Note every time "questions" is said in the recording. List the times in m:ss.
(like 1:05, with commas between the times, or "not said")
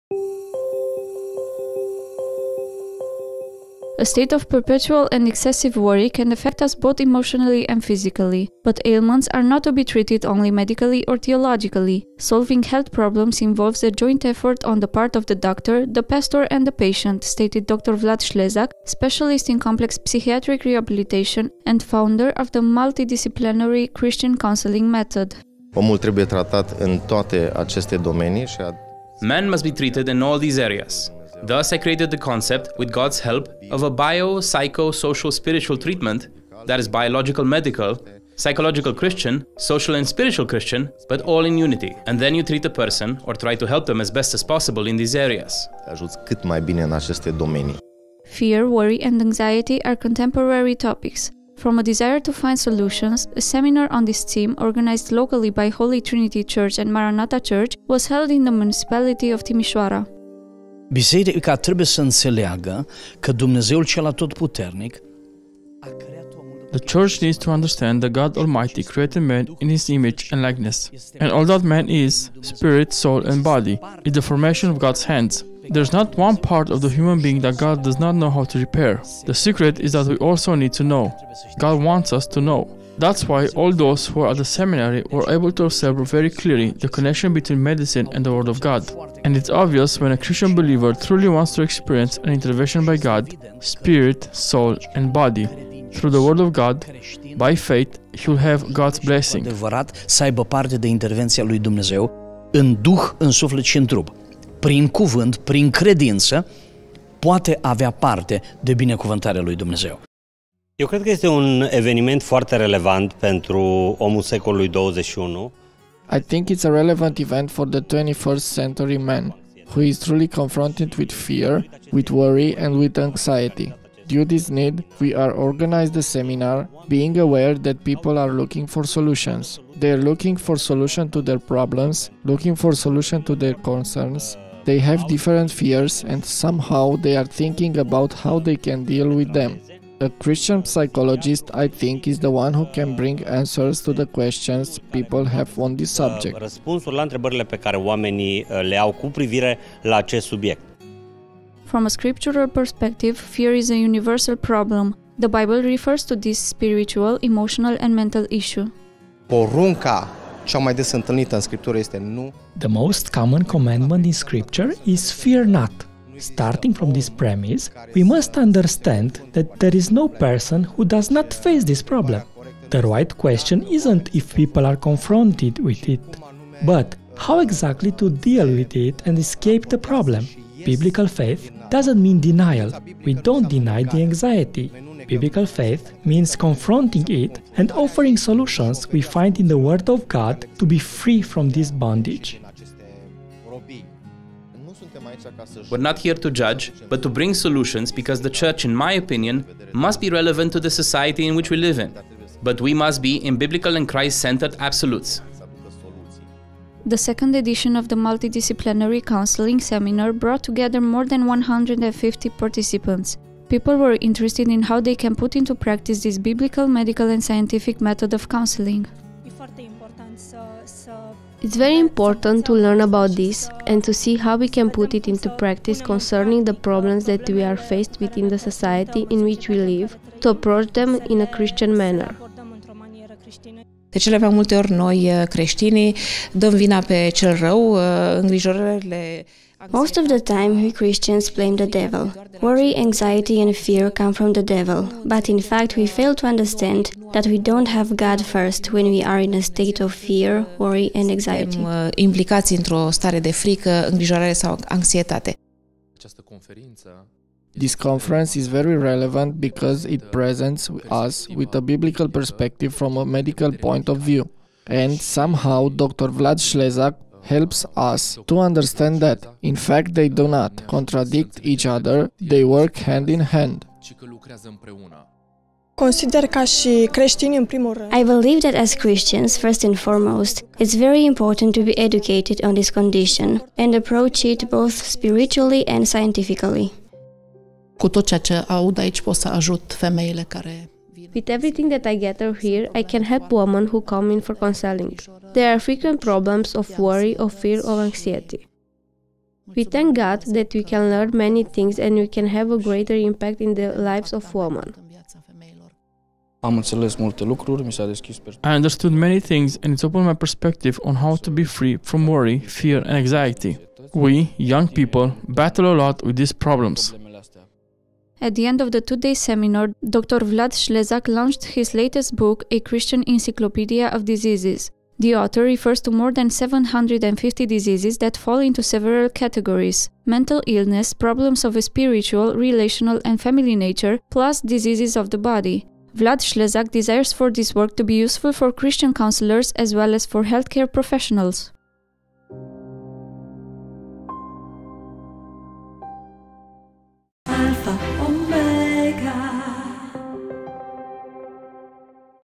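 2:24, 2:53.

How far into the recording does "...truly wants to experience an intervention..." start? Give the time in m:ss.
1:30.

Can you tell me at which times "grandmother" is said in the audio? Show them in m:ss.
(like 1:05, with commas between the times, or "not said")
not said.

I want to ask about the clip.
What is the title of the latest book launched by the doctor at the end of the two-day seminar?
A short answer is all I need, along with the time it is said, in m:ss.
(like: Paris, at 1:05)
A Christian Encyclopedia of Diseases, at 5:22.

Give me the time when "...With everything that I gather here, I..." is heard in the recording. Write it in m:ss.
4:51.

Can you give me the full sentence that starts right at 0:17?
Vlad Schlezak, specialist in complex psychiatric rehabilitation and founder of the multidisciplinary Christian counseling method.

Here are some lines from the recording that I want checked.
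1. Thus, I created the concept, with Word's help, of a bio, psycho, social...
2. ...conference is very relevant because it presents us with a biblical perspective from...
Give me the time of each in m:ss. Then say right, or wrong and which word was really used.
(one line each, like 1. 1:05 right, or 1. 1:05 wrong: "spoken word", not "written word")
1. 0:31 wrong: "God", not "Word"
2. 4:17 right.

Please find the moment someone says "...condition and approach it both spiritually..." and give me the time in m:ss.
4:42.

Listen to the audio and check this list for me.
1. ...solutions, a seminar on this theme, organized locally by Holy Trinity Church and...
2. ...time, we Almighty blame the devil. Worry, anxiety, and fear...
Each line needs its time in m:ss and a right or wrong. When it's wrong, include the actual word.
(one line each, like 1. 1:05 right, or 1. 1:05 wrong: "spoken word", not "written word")
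1. 0:52 right
2. 4:00 wrong: "Christians", not "Almighty".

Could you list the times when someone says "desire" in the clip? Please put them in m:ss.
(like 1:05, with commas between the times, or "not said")
0:51, 5:36.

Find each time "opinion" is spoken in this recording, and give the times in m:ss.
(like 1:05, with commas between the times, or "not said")
3:18.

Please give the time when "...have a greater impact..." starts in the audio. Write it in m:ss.
5:02.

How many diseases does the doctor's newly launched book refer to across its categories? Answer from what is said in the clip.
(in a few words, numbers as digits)
More than 750.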